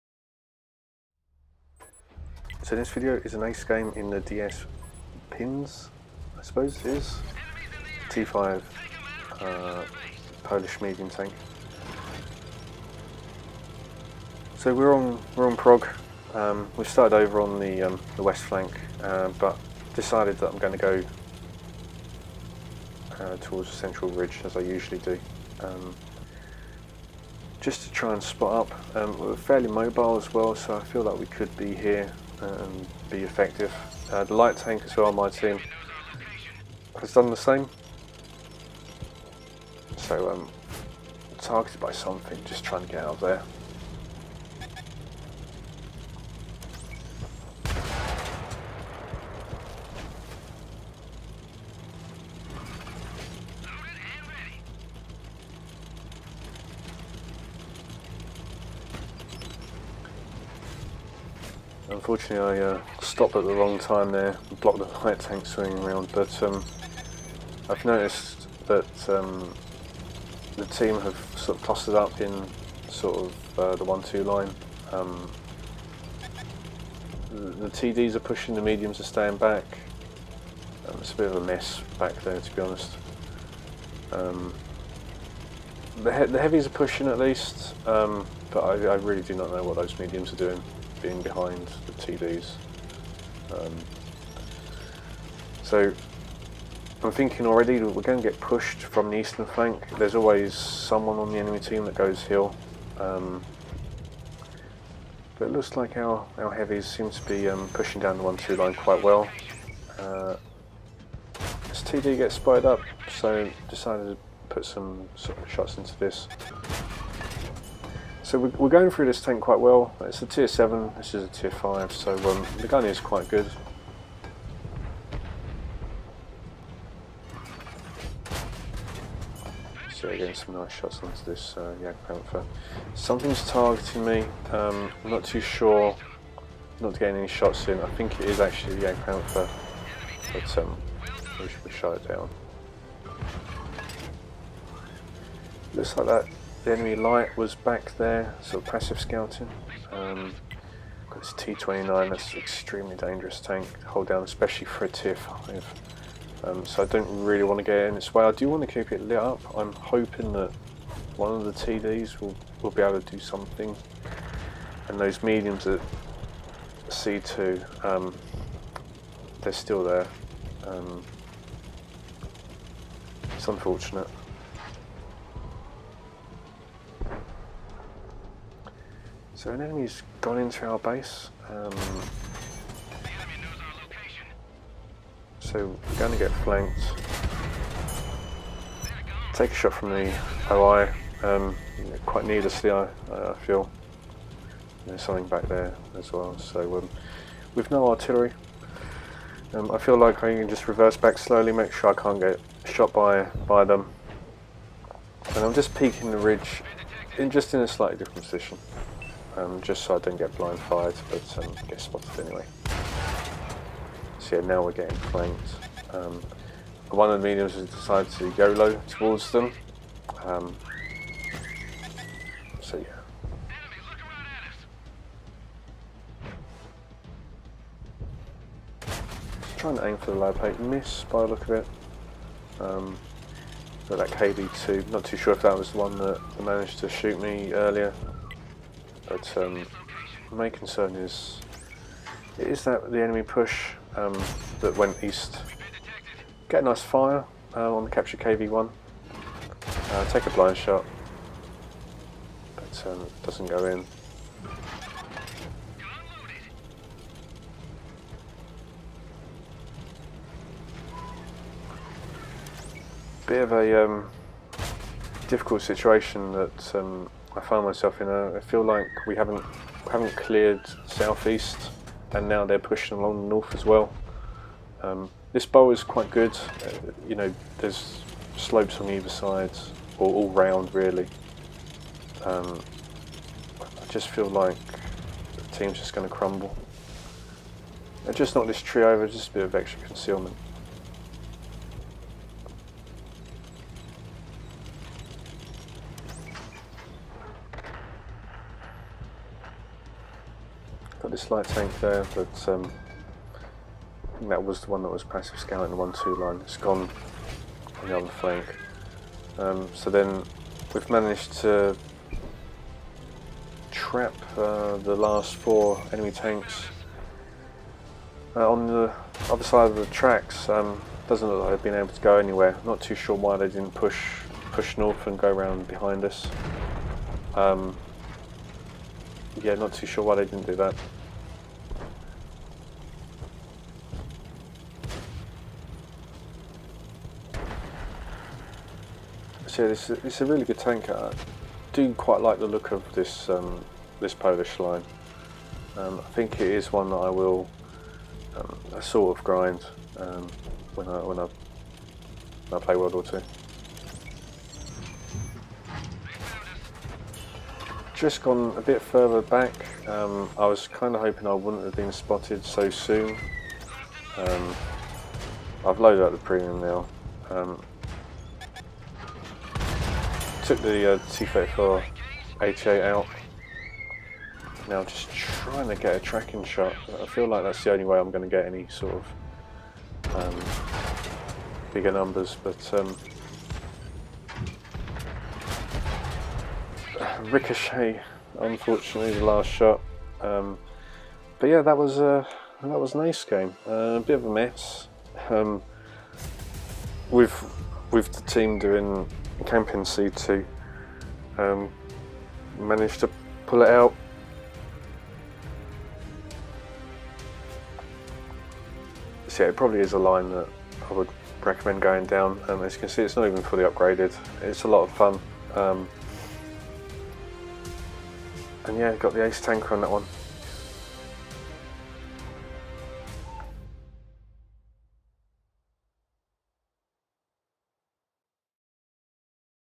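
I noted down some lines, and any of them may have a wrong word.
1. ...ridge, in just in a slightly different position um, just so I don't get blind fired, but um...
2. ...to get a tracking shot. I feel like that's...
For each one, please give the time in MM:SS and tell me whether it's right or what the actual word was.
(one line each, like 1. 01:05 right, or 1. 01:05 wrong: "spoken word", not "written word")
1. 03:26 right
2. 06:15 right.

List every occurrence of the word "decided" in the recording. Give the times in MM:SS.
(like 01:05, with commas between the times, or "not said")
00:19, 01:53, 03:37.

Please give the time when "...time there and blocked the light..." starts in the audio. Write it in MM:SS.
01:03.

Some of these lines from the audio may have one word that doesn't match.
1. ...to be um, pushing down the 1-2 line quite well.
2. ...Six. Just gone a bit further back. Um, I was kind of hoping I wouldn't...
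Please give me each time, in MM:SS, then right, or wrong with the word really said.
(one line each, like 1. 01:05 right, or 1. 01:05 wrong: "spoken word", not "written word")
1. 01:47 right
2. 05:53 wrong: "Two", not "Six".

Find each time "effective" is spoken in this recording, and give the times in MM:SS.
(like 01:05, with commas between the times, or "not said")
00:33.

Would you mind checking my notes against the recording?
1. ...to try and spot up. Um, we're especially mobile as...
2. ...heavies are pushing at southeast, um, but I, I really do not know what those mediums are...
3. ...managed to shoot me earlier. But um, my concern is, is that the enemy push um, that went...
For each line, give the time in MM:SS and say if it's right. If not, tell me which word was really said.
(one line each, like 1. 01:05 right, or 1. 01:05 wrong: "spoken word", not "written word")
1. 00:27 wrong: "fairly", not "especially"
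2. 01:26 wrong: "least", not "southeast"
3. 03:56 right.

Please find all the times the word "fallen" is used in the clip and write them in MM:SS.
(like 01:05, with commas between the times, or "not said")
not said.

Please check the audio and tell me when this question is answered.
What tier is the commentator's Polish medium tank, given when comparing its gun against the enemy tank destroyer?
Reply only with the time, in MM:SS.
02:00.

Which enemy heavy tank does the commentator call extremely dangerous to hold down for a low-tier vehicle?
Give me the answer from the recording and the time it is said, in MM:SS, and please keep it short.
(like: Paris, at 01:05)
T-29, at 02:31.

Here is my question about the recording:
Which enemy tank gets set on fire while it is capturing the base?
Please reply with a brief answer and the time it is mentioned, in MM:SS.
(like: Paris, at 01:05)
KV-1, at 04:08.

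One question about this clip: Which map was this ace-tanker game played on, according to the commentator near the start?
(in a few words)
Prague.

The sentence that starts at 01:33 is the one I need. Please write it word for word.
Um, so I'm thinking already that we're going to get pushed from the eastern flank.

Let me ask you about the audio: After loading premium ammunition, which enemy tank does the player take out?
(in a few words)
T-34 HA.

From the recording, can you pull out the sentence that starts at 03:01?
Um, so we're going to get flanked.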